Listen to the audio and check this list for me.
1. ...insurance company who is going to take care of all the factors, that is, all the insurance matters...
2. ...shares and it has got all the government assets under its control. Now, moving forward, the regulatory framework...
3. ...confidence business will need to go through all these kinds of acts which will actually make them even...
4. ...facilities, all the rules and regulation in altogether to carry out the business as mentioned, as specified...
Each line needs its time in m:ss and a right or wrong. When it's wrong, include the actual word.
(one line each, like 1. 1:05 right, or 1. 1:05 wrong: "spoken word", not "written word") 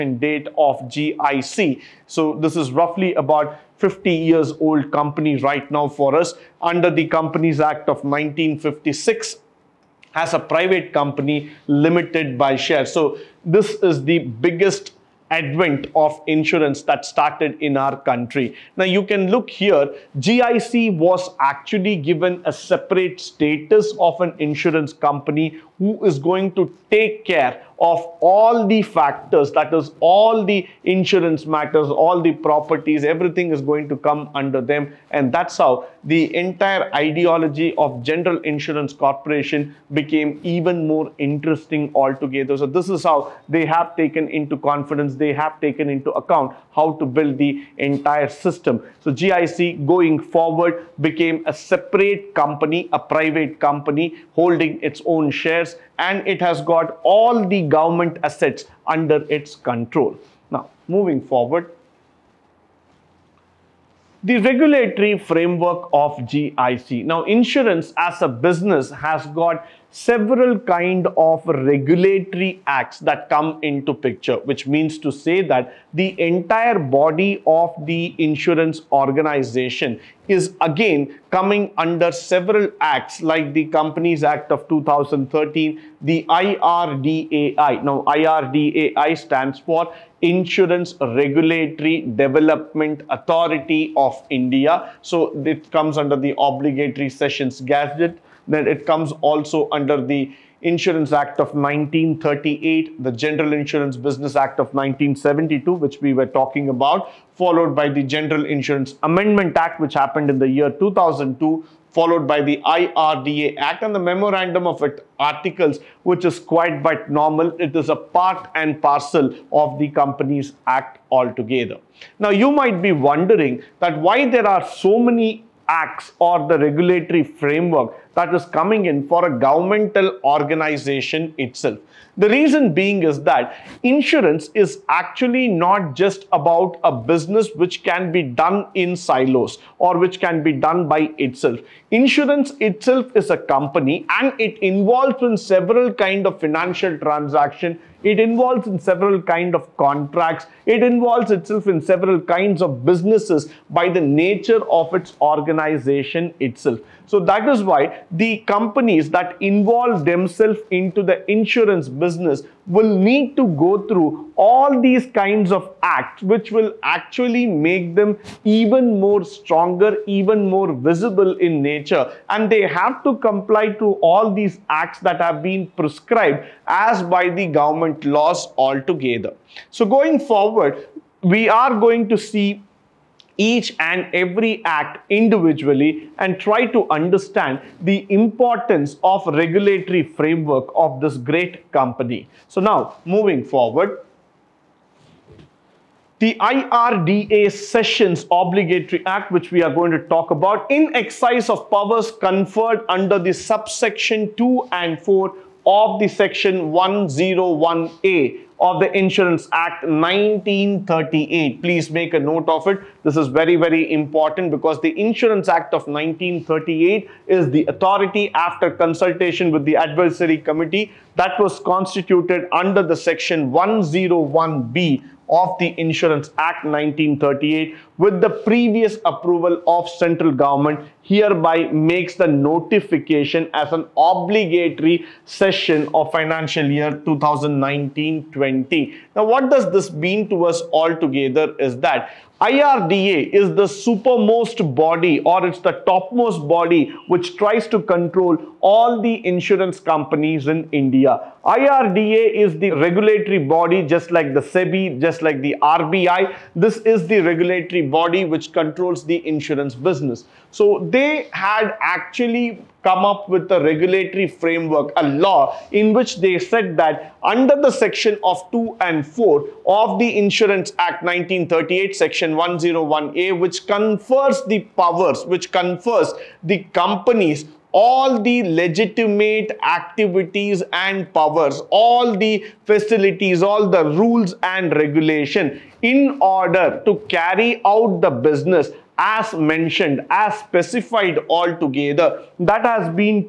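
1. 0:24 right
2. 0:55 right
3. 2:41 wrong: "insurance", not "confidence"
4. 4:42 wrong: "order", not "altogether".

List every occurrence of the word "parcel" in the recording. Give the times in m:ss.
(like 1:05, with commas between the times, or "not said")
1:58.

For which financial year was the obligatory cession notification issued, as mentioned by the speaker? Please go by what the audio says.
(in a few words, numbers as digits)
2019-20.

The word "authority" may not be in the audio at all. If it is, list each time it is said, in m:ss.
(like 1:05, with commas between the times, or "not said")
1:33, 3:37.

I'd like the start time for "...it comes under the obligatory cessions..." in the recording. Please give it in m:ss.
1:35.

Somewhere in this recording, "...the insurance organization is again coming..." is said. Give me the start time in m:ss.
1:17.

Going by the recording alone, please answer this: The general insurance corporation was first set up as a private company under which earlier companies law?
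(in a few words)
Companies Act of 1956.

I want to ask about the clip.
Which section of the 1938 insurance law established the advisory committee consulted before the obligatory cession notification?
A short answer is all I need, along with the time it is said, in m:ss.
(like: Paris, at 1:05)
section 101B, at 3:42.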